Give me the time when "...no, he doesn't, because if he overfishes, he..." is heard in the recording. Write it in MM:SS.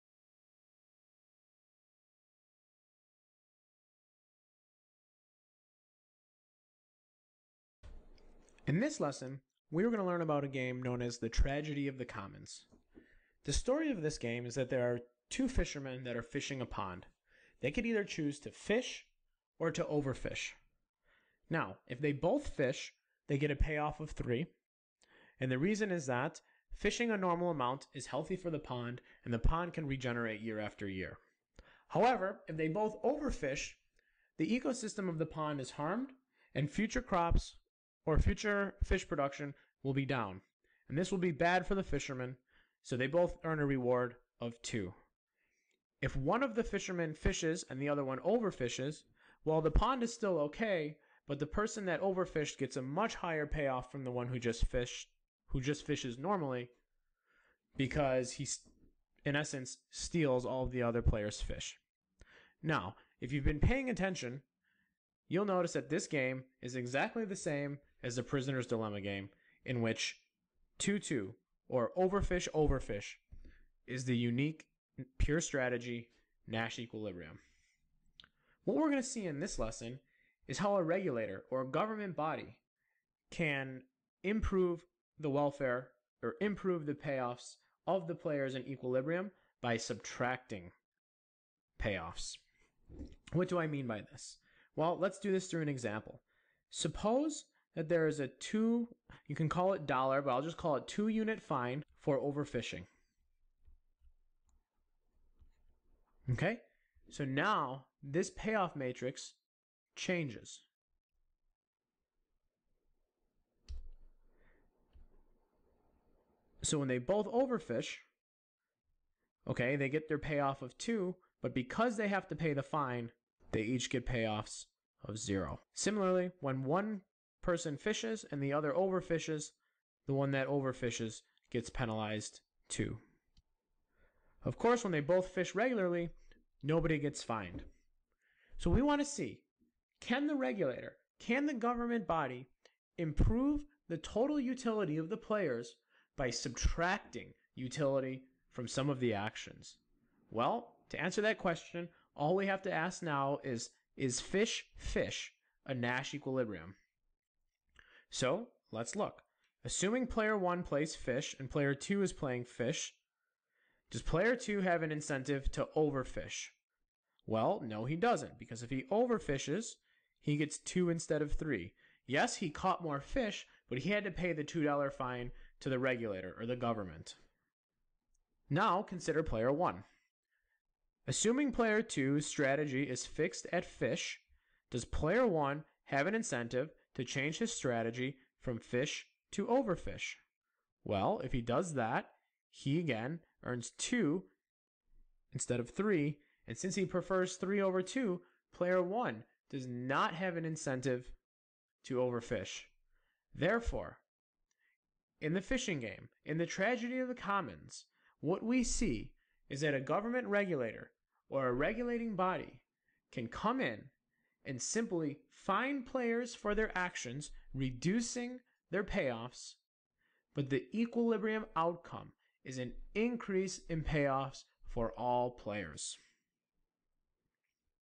02:47.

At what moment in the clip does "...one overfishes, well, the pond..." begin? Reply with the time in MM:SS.
00:48.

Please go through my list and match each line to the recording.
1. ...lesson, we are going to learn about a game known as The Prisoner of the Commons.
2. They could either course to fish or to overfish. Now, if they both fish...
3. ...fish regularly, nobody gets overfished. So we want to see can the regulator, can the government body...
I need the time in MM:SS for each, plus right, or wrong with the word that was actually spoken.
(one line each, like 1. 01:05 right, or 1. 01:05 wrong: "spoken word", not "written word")
1. 00:09 wrong: "Tragedy", not "Prisoner"
2. 00:17 wrong: "choose", not "course"
3. 02:15 wrong: "fined", not "overfished".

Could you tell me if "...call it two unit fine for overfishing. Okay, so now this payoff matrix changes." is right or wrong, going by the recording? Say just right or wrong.
right.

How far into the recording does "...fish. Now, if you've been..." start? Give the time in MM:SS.
01:01.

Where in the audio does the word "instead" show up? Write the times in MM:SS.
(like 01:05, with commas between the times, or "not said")
02:50, 03:15.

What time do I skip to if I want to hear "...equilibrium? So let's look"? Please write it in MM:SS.
02:36.